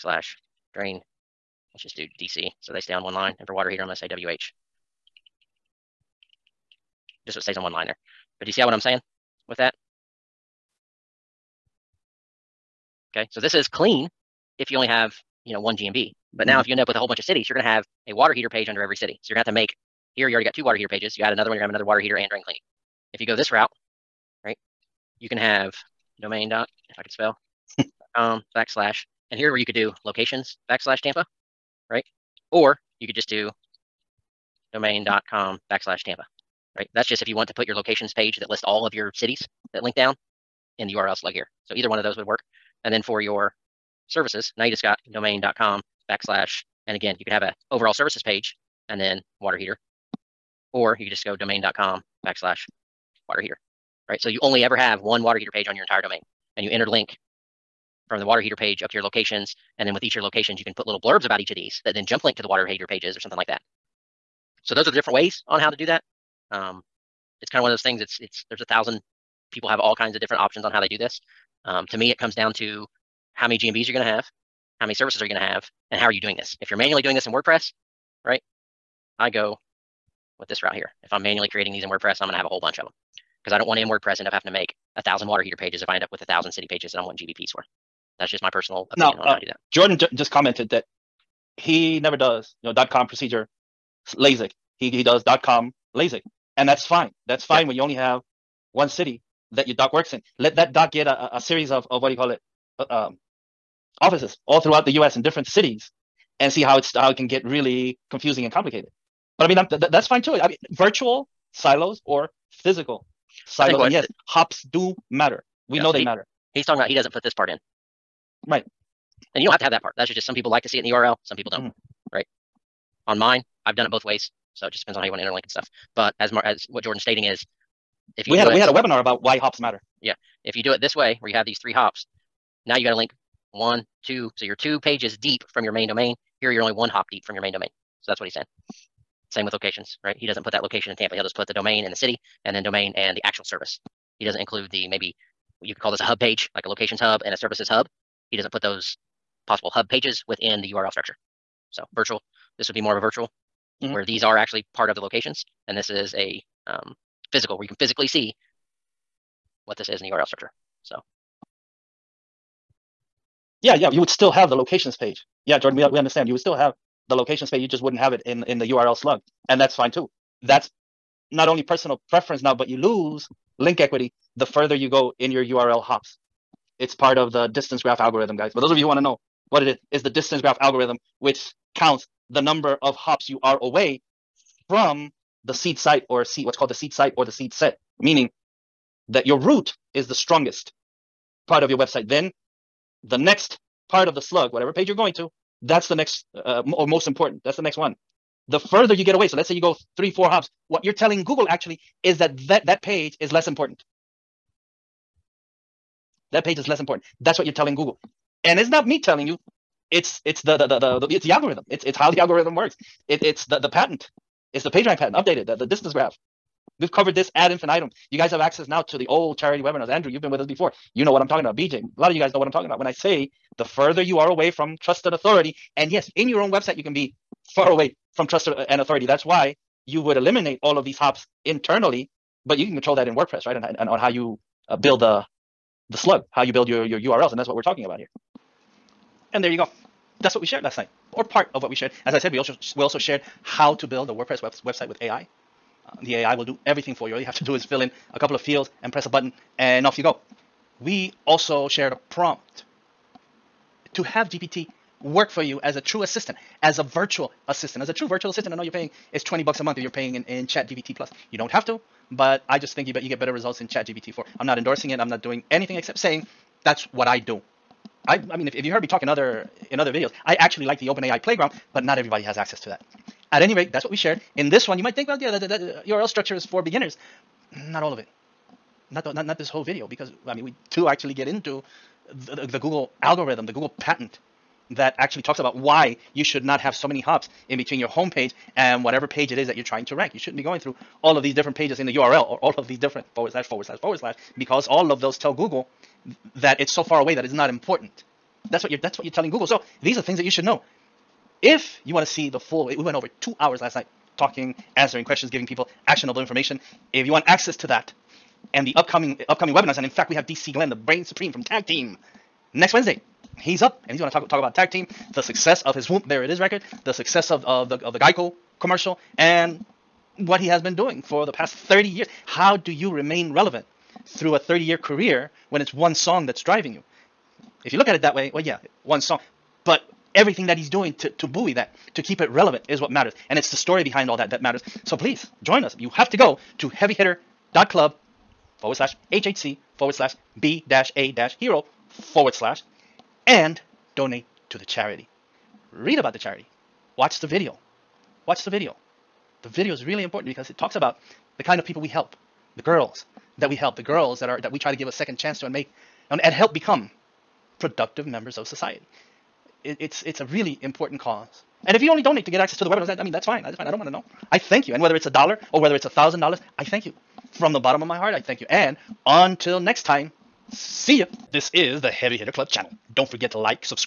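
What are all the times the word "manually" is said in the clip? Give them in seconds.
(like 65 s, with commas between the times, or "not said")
76 s, 81 s.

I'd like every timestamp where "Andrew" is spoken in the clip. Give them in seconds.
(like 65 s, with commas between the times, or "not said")
219 s.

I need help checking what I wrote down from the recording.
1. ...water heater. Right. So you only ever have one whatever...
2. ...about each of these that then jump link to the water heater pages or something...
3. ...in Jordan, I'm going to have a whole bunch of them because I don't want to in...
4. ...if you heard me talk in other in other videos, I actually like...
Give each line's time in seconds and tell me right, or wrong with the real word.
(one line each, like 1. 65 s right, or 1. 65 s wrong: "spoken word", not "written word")
1. 53 s wrong: "water", not "whatever"
2. 61 s right
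3. 81 s wrong: "WordPress", not "Jordan"
4. 268 s right.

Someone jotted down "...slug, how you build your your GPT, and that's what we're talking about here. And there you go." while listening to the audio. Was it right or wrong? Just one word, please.
wrong.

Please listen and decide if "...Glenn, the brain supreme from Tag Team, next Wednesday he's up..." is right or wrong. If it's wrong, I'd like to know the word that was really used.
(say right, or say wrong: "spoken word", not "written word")
right.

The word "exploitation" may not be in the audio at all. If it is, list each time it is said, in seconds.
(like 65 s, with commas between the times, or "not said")
not said.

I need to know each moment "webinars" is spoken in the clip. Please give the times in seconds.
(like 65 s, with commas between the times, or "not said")
128 s, 219 s, 309 s, 362 s.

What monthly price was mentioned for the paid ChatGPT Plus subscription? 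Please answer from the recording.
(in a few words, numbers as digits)
20 bucks.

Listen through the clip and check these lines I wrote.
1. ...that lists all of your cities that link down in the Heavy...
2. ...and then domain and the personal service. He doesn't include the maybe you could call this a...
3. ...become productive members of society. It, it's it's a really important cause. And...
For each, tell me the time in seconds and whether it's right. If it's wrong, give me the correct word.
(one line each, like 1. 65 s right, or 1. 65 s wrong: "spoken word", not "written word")
1. 38 s wrong: "URL", not "Heavy"
2. 142 s wrong: "actual", not "personal"
3. 356 s right.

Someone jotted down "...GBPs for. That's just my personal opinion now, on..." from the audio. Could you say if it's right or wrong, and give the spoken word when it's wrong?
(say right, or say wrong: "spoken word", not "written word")
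right.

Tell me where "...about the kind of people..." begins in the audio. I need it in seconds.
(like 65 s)
350 s.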